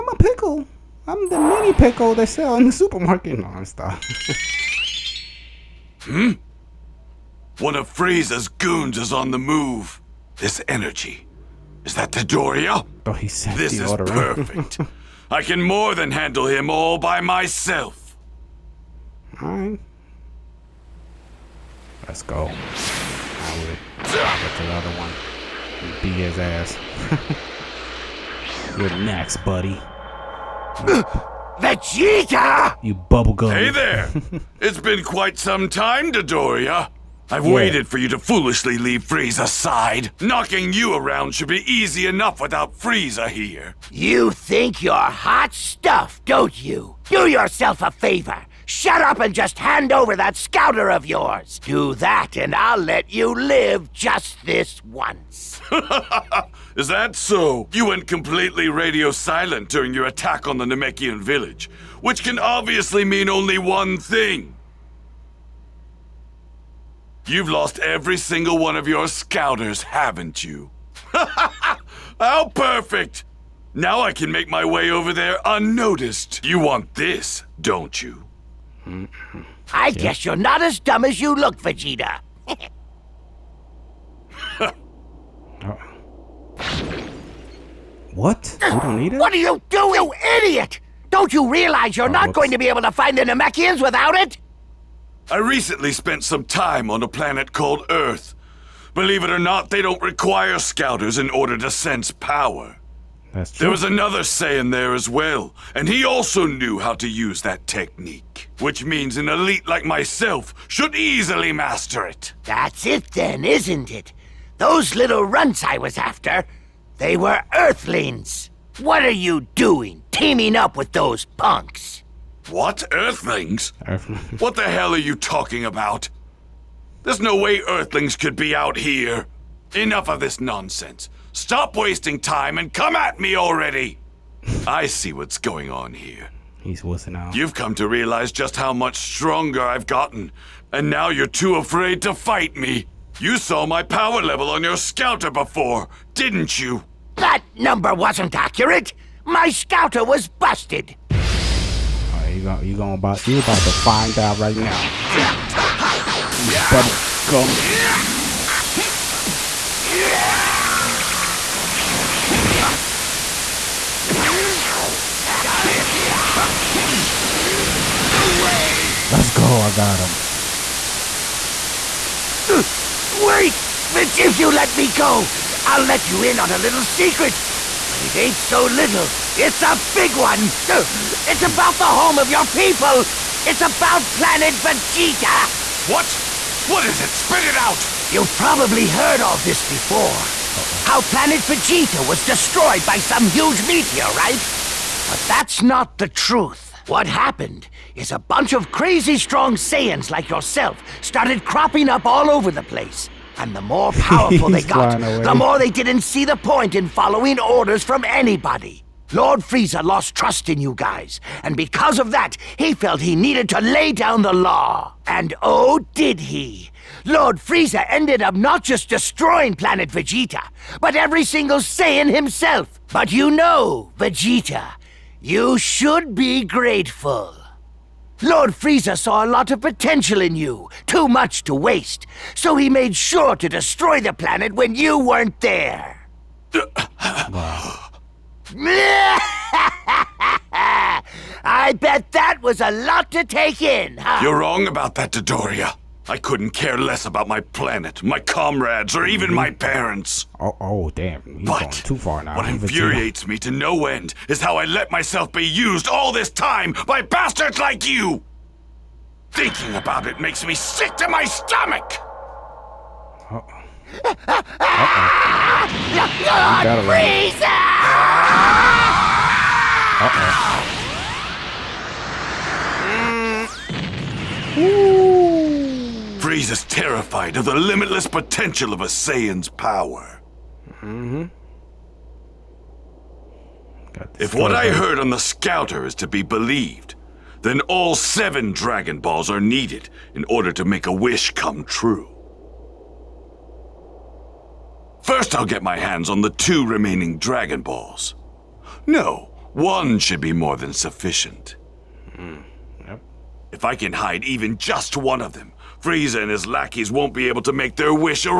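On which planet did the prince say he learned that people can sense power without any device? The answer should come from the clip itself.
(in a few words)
Earth.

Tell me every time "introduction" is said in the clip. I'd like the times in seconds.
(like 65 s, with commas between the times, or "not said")
not said.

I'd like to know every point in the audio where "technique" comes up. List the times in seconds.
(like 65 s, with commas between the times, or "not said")
107 s.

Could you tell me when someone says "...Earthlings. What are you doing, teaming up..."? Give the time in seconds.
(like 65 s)
117 s.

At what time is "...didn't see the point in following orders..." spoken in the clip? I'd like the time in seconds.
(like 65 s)
205 s.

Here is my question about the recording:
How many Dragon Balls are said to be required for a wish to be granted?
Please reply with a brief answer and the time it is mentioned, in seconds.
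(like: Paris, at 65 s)
7, at 287 s.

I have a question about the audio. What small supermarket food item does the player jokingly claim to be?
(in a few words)
mini pickle.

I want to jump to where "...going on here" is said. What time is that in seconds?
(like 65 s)
135 s.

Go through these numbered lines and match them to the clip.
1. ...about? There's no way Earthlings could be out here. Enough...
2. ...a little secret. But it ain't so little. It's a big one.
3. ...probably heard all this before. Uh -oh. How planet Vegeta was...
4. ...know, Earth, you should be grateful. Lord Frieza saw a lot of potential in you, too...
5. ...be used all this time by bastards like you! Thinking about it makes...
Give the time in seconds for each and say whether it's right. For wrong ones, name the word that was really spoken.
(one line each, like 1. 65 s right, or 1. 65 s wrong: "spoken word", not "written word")
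1. 125 s right
2. 176 s right
3. 188 s right
4. 223 s wrong: "Vegeta", not "Earth"
5. 255 s right.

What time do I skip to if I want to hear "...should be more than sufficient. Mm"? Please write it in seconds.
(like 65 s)
299 s.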